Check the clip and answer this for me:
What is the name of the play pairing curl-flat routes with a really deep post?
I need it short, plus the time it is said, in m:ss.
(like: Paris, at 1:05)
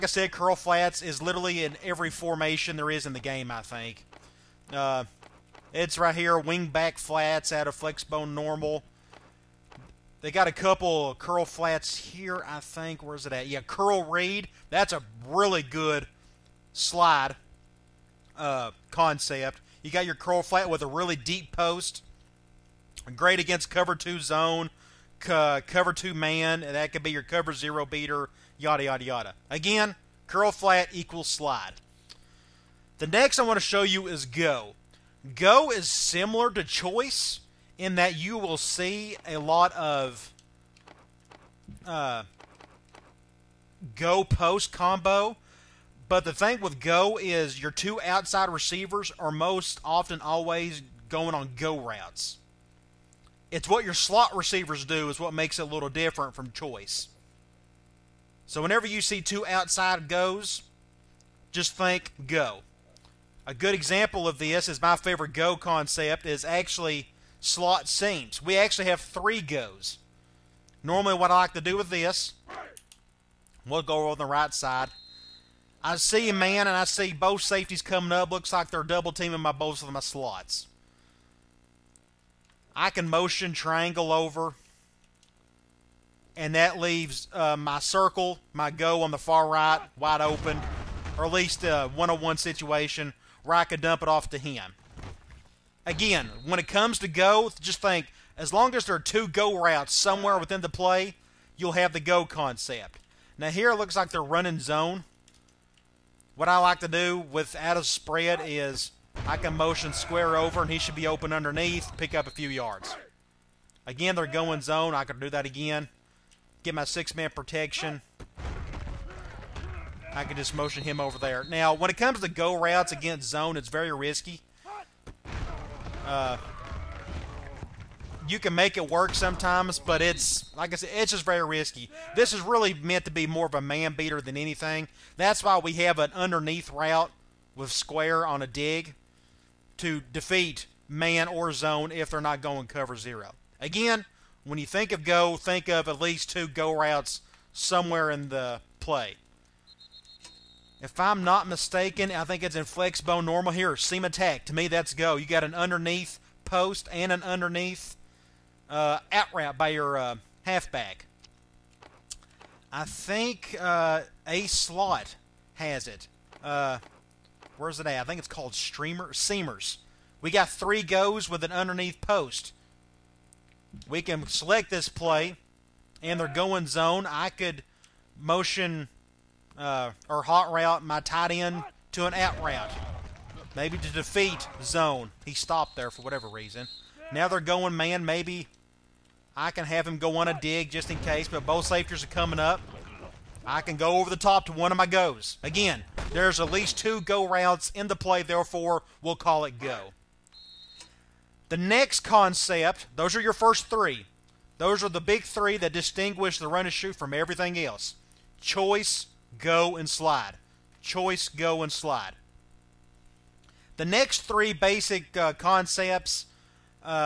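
Curl read, at 0:13.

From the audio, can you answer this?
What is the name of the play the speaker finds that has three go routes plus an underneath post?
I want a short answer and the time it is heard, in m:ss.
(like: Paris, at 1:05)
Streamer seamers, at 2:48.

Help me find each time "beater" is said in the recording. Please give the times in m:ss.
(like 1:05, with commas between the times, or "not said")
0:27, 2:13.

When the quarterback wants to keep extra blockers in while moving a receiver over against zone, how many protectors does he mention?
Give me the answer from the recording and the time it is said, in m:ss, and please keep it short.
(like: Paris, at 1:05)
6, at 1:56.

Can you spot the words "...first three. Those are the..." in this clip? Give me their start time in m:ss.
3:23.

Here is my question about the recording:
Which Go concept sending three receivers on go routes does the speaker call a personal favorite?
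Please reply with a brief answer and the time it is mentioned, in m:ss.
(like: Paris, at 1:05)
Slot seams, at 1:07.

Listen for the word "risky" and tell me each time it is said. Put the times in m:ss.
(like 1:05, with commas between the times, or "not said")
2:03, 2:11.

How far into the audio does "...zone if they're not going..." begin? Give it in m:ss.
2:21.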